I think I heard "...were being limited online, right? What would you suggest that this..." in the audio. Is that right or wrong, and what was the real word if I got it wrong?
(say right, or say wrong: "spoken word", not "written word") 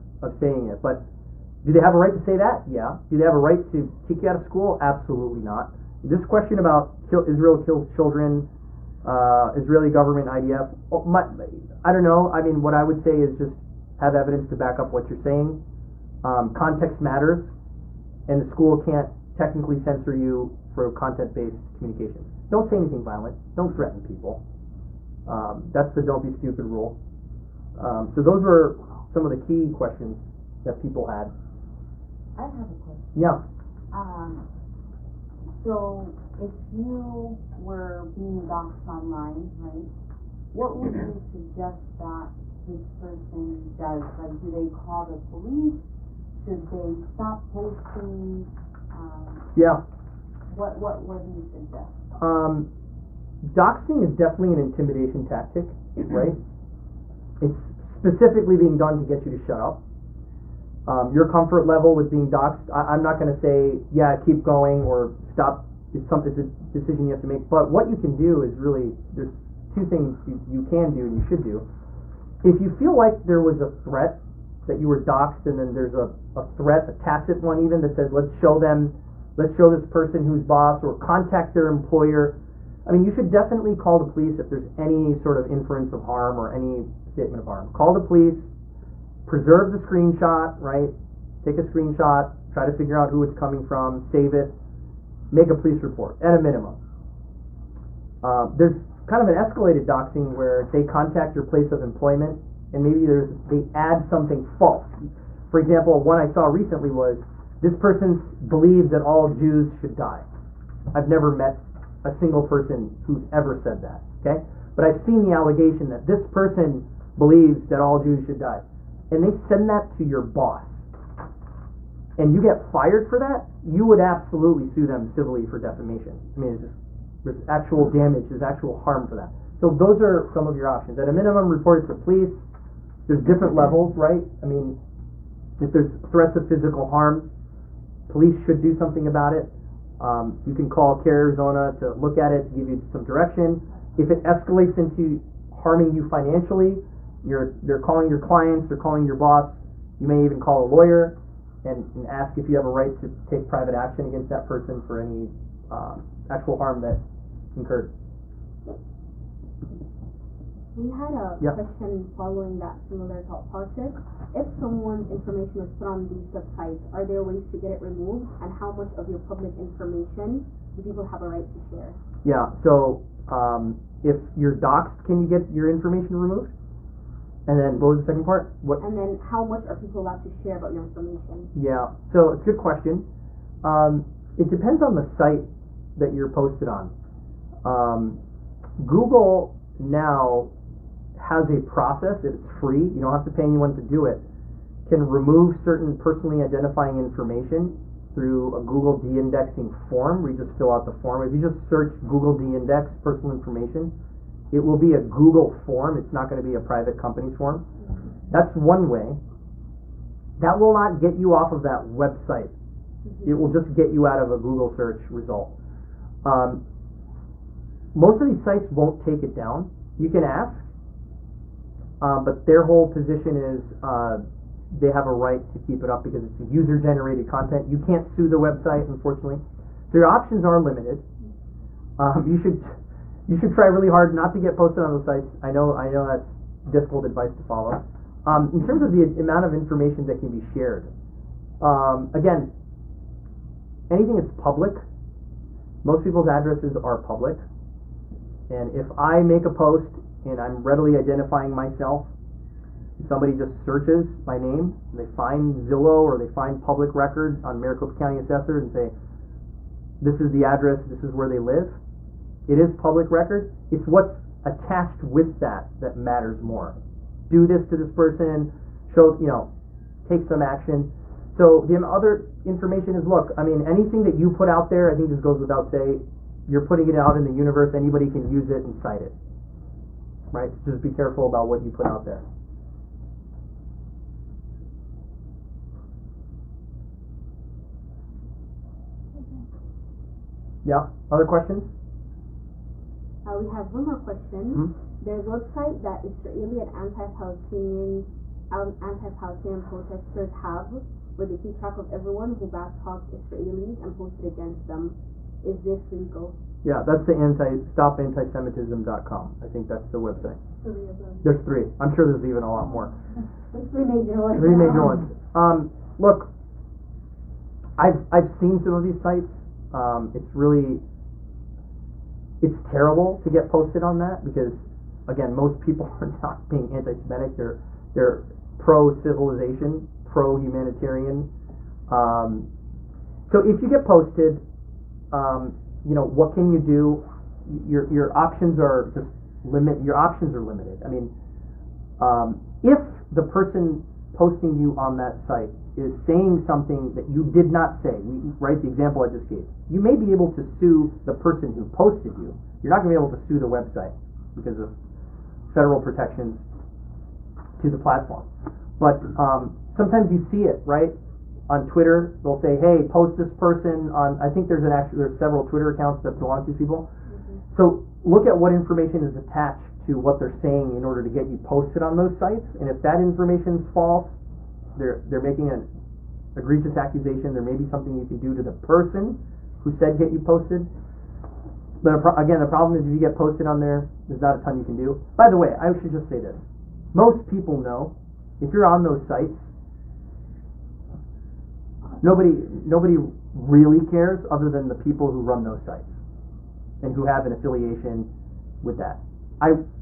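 wrong: "doxxed", not "limited".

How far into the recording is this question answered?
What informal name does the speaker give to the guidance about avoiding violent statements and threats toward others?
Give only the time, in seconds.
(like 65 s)
25 s.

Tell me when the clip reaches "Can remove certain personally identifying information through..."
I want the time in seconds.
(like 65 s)
194 s.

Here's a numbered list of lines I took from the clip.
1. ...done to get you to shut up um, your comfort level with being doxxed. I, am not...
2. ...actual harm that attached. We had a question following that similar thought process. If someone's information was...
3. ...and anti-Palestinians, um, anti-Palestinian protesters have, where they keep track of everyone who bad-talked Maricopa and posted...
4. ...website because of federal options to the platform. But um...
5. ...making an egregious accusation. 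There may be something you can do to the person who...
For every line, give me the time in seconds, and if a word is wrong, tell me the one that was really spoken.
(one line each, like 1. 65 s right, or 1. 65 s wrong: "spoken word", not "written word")
1. 58 s right
2. 156 s wrong: "incurred", not "attached"
3. 296 s wrong: "Israelis", not "Maricopa"
4. 353 s wrong: "protections", not "options"
5. 375 s right.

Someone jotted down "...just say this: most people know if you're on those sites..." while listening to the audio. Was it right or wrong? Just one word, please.
right.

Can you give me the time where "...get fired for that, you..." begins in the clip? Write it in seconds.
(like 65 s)
122 s.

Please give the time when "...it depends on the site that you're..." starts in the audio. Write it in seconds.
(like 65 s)
184 s.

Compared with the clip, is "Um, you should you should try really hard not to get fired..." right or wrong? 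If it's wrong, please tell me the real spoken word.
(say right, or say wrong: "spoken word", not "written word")
wrong: "posted", not "fired".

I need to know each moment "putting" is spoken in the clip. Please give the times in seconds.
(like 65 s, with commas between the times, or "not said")
276 s.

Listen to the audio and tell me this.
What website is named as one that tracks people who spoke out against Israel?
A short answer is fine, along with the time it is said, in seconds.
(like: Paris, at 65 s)
stopantisemitism.com, at 307 s.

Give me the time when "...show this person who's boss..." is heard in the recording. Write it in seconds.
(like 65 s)
79 s.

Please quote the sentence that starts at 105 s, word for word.
For example, one I saw recently was this person believes that all Jews should die.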